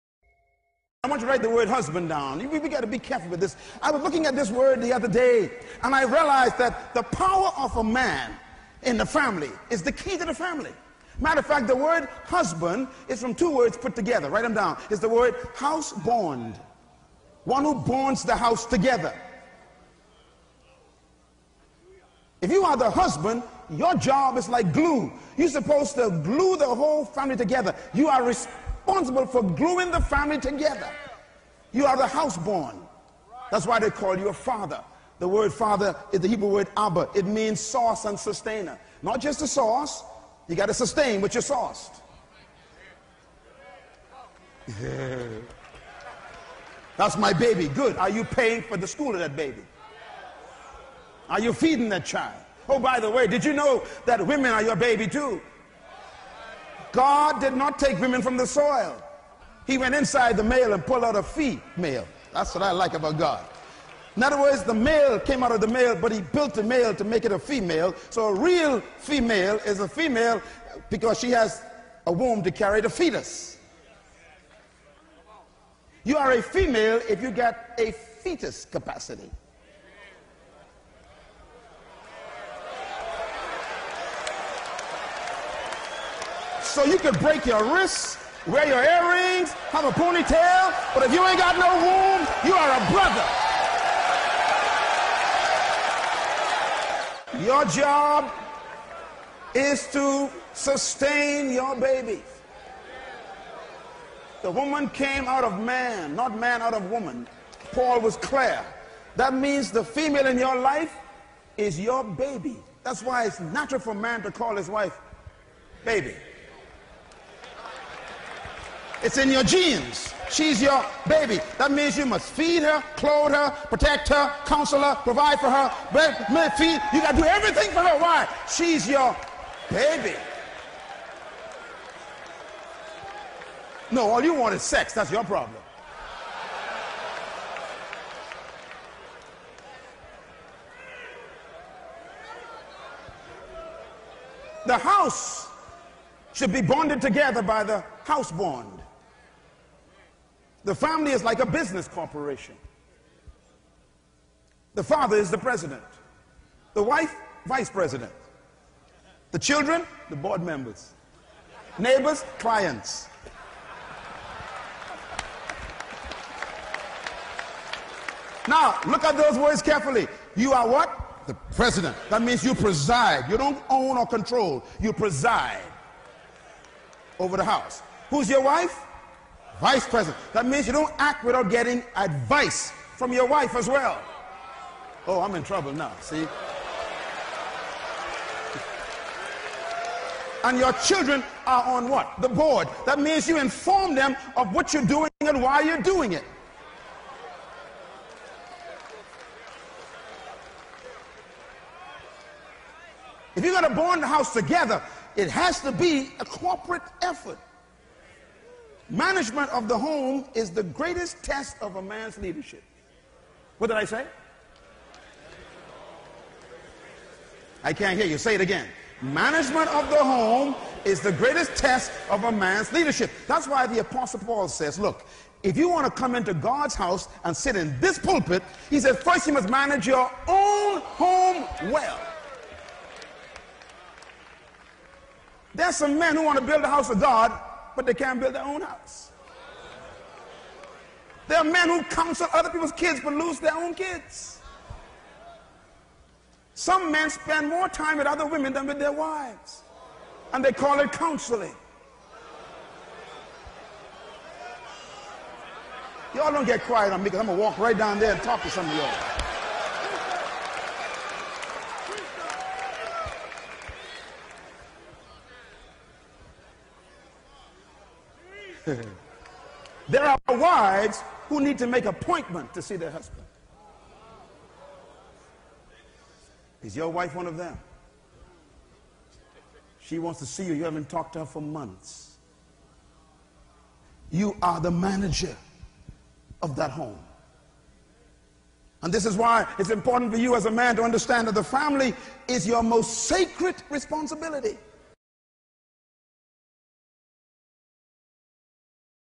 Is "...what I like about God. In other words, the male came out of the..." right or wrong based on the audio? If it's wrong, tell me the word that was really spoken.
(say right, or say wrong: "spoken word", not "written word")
right.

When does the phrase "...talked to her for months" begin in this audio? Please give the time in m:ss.
4:40.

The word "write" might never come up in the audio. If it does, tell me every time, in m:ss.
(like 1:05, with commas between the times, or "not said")
0:01, 0:14.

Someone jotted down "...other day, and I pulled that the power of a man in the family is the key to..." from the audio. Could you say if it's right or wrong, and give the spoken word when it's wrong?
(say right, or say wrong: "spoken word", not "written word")
wrong: "realized", not "pulled".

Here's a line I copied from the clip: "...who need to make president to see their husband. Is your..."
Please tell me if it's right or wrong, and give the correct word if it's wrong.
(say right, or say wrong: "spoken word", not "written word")
wrong: "appointment", not "president".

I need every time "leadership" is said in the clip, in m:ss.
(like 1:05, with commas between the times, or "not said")
3:32, 3:42.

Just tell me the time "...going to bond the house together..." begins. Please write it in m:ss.
3:23.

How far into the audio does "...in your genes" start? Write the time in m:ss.
1:59.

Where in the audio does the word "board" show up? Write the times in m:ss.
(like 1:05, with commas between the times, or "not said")
2:40, 3:12.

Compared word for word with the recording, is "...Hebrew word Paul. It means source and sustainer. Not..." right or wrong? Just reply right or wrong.
wrong.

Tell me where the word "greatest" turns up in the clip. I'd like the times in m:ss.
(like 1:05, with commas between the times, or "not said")
3:30, 3:41.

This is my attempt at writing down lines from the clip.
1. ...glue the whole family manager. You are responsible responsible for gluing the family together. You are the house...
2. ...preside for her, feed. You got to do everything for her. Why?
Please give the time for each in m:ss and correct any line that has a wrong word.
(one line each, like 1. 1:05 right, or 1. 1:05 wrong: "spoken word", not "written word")
1. 0:26 wrong: "together", not "manager"
2. 2:04 wrong: "provide", not "preside".